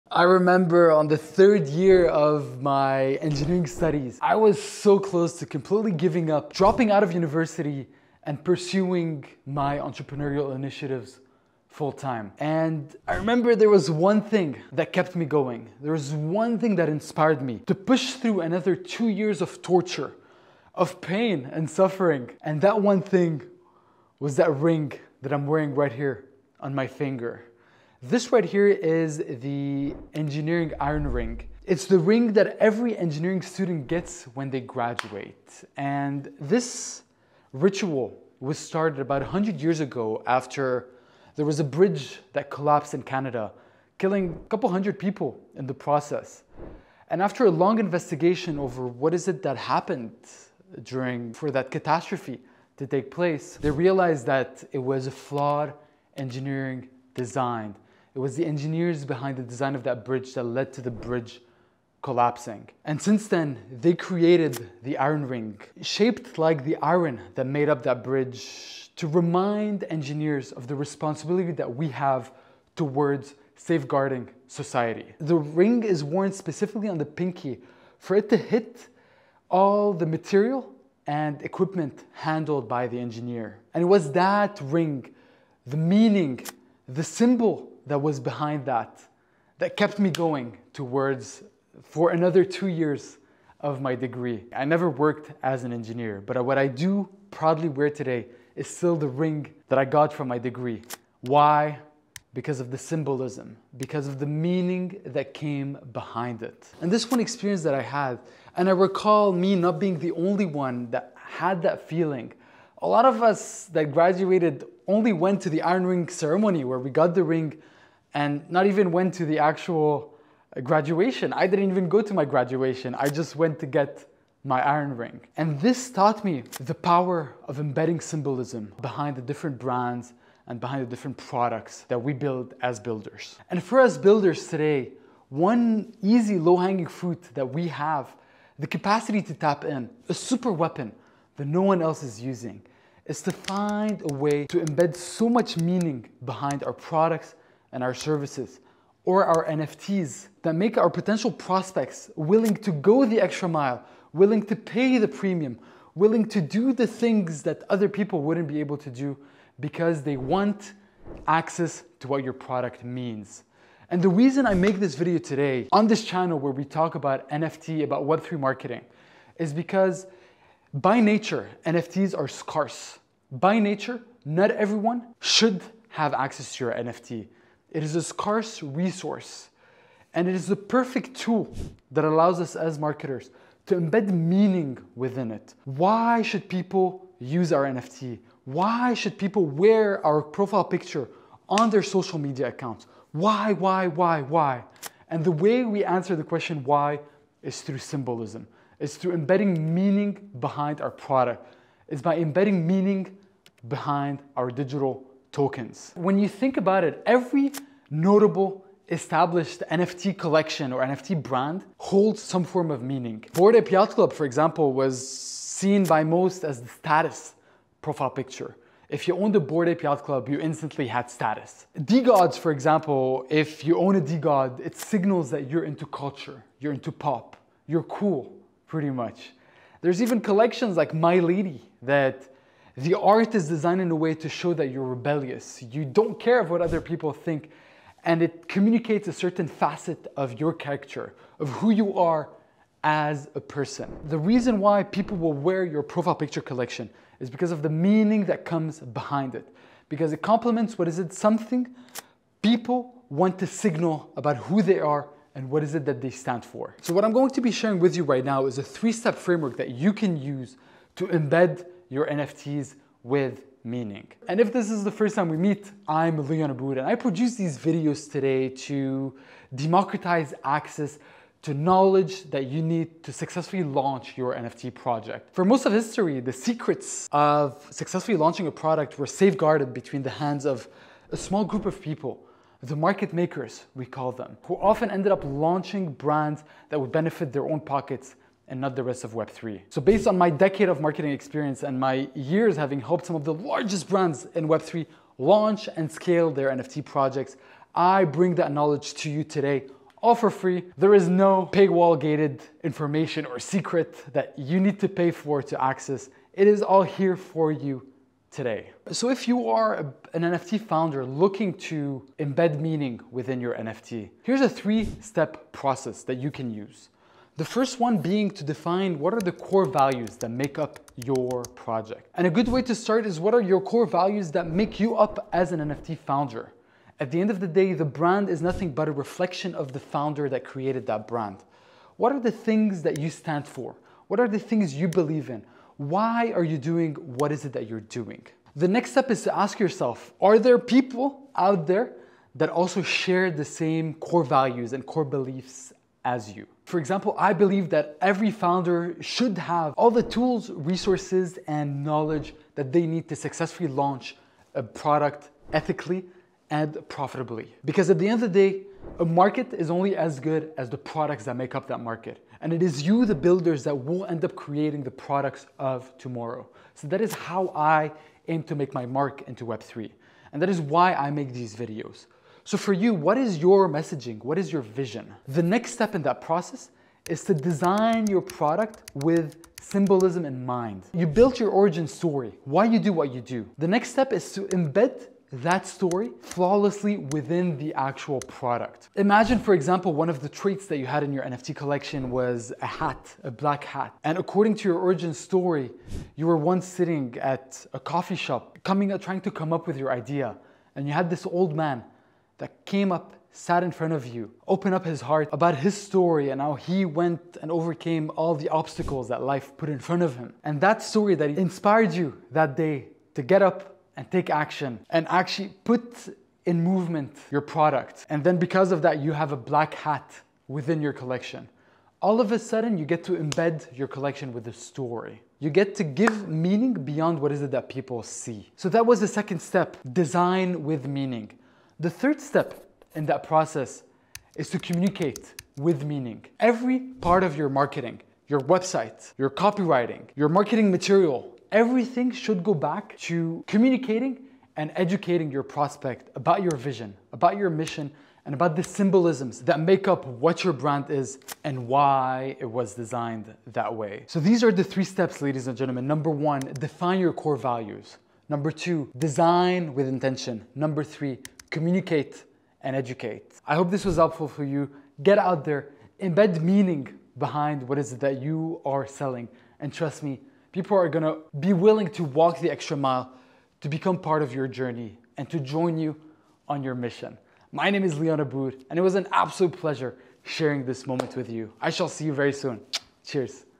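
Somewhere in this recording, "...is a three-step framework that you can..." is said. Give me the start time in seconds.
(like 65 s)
258 s.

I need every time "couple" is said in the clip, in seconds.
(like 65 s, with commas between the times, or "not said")
44 s.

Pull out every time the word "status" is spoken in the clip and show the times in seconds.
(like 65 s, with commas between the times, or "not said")
216 s, 221 s.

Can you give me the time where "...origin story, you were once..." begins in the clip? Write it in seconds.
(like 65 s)
394 s.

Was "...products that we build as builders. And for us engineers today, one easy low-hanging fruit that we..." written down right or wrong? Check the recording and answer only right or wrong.
wrong.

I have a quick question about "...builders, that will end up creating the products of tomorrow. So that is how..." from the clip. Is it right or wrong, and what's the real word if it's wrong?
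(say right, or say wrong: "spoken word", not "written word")
right.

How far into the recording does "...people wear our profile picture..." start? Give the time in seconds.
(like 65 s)
189 s.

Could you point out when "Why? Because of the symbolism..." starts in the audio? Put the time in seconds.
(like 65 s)
101 s.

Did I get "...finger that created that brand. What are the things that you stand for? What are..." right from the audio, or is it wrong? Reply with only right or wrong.
wrong.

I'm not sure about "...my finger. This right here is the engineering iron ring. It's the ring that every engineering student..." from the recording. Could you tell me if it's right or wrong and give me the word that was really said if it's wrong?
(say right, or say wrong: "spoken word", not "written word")
right.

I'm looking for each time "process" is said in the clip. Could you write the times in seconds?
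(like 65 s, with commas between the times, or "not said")
45 s, 315 s, 376 s, 433 s.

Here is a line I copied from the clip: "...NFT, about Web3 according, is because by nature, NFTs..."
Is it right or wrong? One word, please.
wrong.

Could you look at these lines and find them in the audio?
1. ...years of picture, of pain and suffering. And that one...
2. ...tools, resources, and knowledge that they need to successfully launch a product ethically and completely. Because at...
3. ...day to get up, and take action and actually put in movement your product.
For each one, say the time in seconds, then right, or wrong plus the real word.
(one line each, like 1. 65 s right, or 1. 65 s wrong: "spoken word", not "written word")
1. 19 s wrong: "torture", not "picture"
2. 350 s wrong: "profitably", not "completely"
3. 412 s right.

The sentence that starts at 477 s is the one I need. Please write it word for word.
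My name is Leon Abboud, and it was an absolute pleasure sharing this moment with you.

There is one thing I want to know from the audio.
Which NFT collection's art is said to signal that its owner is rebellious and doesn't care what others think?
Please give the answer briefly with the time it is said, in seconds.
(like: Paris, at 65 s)
Milady, at 230 s.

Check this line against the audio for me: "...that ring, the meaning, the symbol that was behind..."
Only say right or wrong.
right.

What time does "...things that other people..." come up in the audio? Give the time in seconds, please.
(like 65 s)
156 s.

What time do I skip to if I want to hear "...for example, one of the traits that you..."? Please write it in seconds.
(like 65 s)
389 s.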